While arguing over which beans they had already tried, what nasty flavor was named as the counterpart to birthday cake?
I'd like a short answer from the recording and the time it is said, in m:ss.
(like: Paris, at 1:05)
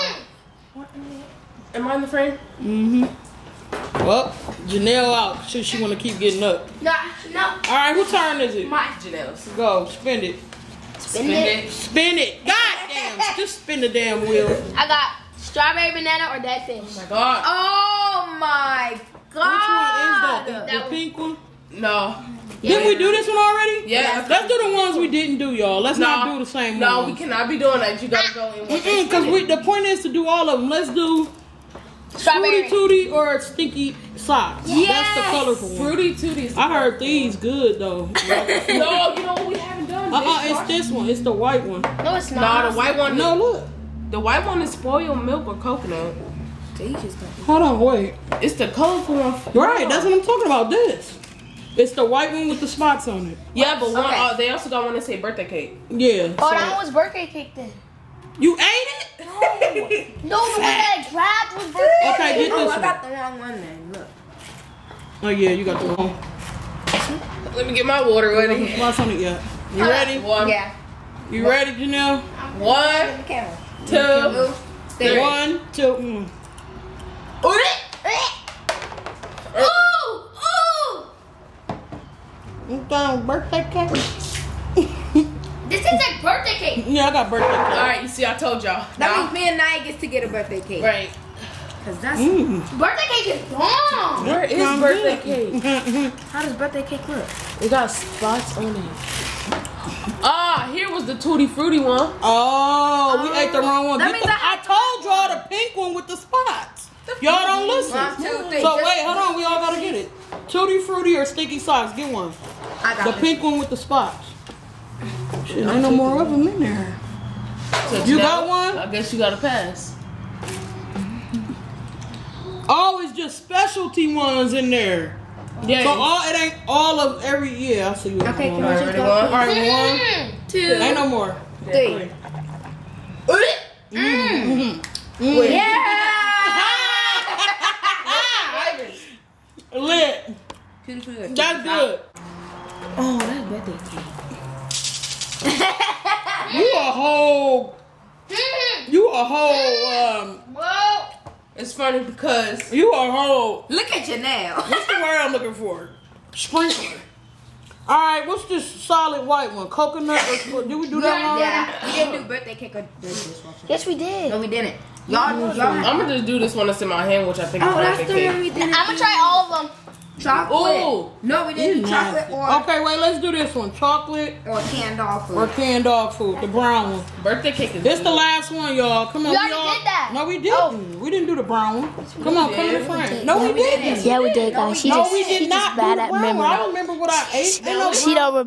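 dishwasher, at 2:43.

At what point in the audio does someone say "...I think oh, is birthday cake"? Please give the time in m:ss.
2:47.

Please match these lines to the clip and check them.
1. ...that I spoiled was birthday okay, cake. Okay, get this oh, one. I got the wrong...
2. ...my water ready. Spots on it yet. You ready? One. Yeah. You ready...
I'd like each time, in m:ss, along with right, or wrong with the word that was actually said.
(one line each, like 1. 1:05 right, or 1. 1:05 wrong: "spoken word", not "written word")
1. 1:00 wrong: "grabbed", not "spoiled"
2. 1:07 right.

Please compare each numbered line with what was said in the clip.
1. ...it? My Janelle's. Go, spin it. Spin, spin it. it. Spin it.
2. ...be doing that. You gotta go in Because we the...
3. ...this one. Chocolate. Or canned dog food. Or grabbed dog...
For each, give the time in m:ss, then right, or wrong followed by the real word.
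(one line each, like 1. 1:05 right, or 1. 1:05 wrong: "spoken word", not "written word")
1. 0:08 right
2. 0:27 right
3. 2:53 wrong: "canned", not "grabbed".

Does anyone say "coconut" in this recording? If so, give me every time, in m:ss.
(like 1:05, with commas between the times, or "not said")
0:45, 2:39.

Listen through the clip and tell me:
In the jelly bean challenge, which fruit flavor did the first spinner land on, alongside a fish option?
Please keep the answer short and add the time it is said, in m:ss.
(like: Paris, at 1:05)
strawberry banana, at 0:15.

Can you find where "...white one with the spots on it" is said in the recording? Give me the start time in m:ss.
0:52.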